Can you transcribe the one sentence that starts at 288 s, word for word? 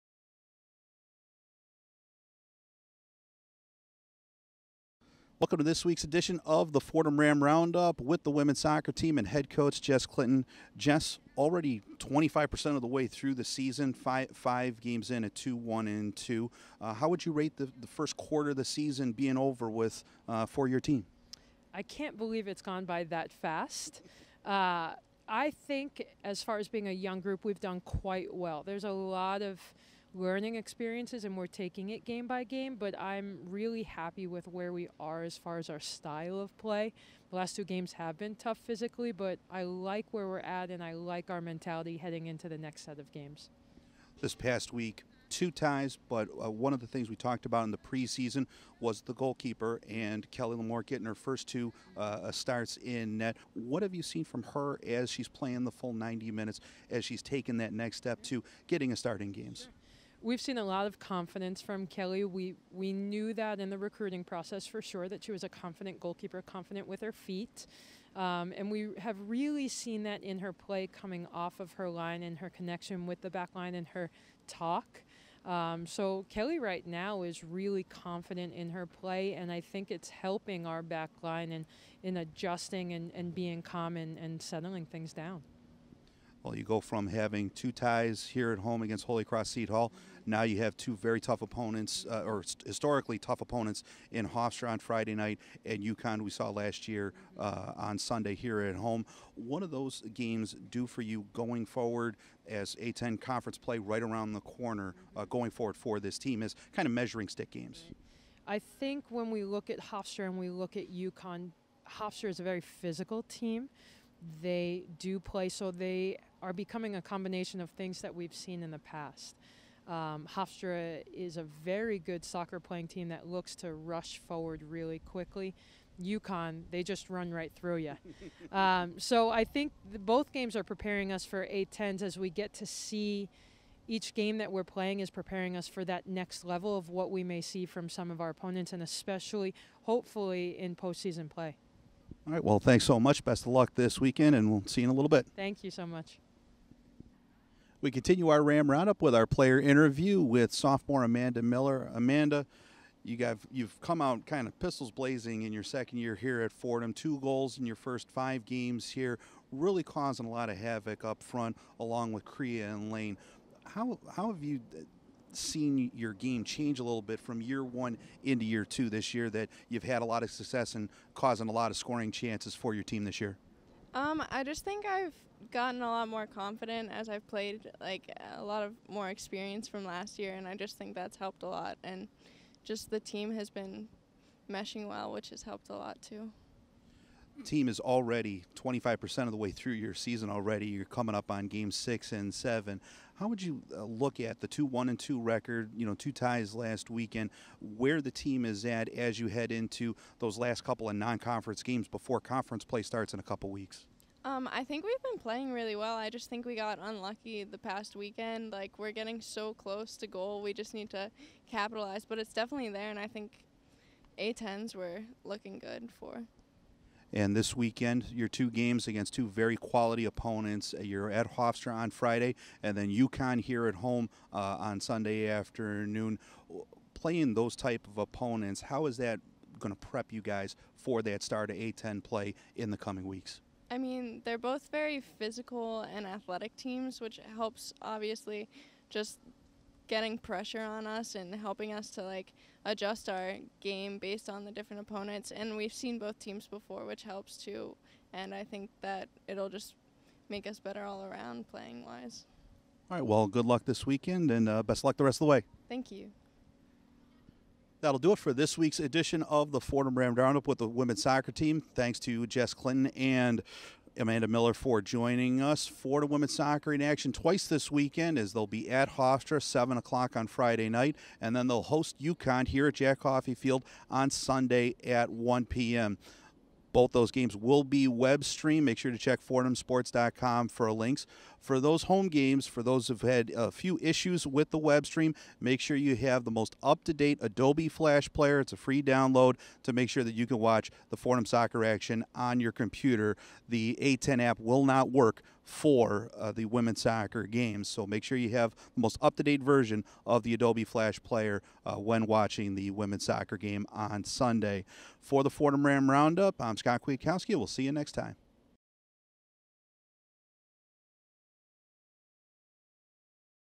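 It's a free download to make sure that you can watch the Fordham soccer action on your computer.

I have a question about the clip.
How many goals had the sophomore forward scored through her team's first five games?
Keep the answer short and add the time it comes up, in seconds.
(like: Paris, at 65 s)
2, at 156 s.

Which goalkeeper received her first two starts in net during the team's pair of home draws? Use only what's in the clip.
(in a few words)
Kelly Lamore.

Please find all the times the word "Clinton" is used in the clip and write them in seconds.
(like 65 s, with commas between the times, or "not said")
10 s, 262 s.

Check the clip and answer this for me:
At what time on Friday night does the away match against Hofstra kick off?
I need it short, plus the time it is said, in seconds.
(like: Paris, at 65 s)
7 o'clock, at 269 s.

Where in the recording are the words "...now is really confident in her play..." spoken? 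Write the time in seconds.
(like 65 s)
76 s.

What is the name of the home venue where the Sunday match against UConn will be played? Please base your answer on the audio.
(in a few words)
Jack Coffey Field.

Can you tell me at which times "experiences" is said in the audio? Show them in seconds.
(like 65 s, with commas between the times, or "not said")
30 s, 179 s.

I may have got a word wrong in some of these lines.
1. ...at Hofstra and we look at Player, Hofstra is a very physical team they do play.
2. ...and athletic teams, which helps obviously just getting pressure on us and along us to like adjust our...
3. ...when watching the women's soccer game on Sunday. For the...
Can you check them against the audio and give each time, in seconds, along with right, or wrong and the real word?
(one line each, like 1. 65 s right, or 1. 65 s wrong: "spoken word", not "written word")
1. 109 s wrong: "UConn", not "Player"
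2. 235 s wrong: "helping", not "along"
3. 301 s right.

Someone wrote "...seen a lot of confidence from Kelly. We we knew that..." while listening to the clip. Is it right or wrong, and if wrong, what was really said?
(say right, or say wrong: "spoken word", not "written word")
right.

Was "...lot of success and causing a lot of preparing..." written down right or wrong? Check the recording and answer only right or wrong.
wrong.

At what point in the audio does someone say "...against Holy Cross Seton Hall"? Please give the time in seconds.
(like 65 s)
88 s.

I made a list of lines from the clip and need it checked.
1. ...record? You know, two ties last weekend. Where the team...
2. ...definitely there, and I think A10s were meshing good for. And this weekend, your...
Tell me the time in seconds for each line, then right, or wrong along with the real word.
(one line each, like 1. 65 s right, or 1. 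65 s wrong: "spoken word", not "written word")
1. 195 s right
2. 212 s wrong: "looking", not "meshing".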